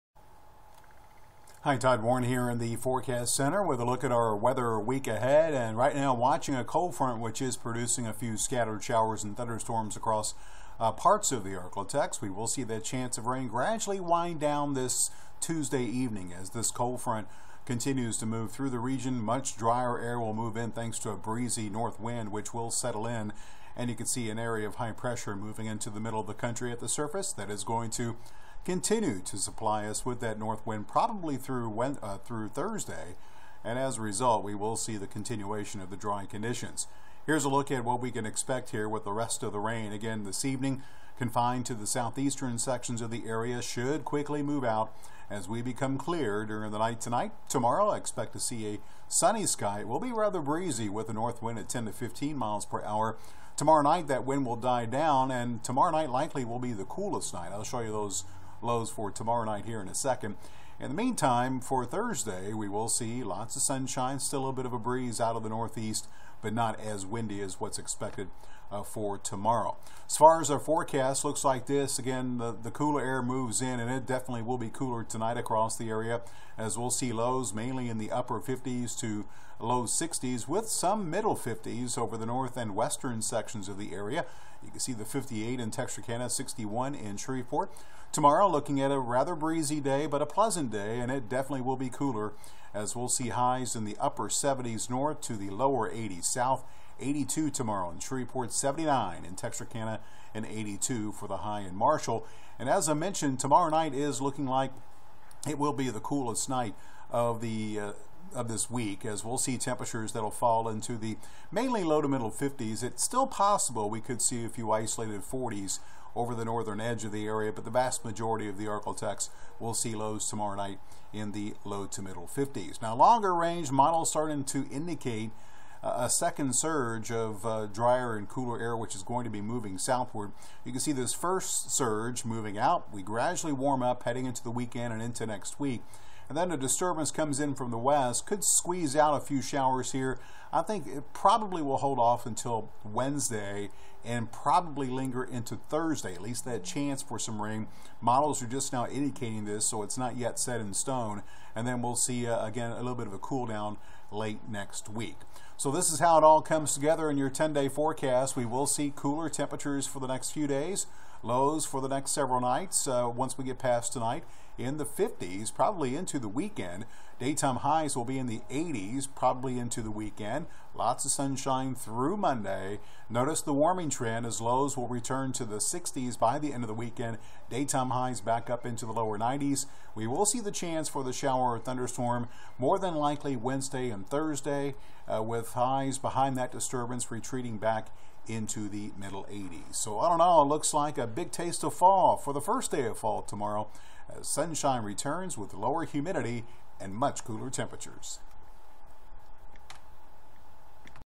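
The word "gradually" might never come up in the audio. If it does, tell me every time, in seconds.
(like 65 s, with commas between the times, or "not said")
13 s, 133 s.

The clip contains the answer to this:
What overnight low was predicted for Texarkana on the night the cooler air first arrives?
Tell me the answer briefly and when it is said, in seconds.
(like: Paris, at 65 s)
58, at 85 s.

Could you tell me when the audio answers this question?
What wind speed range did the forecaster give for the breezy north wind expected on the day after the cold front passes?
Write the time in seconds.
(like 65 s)
51 s.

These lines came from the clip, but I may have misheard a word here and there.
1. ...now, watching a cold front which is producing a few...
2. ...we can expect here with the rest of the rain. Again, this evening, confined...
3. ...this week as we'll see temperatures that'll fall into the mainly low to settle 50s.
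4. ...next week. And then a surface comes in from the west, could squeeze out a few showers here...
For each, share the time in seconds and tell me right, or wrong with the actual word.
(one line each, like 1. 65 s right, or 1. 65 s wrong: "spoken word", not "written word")
1. 5 s right
2. 38 s right
3. 108 s wrong: "middle", not "settle"
4. 135 s wrong: "disturbance", not "surface".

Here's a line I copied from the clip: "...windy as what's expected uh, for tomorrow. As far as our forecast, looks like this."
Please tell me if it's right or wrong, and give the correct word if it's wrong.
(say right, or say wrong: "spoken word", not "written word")
right.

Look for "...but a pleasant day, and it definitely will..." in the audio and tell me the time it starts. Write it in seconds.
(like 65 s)
90 s.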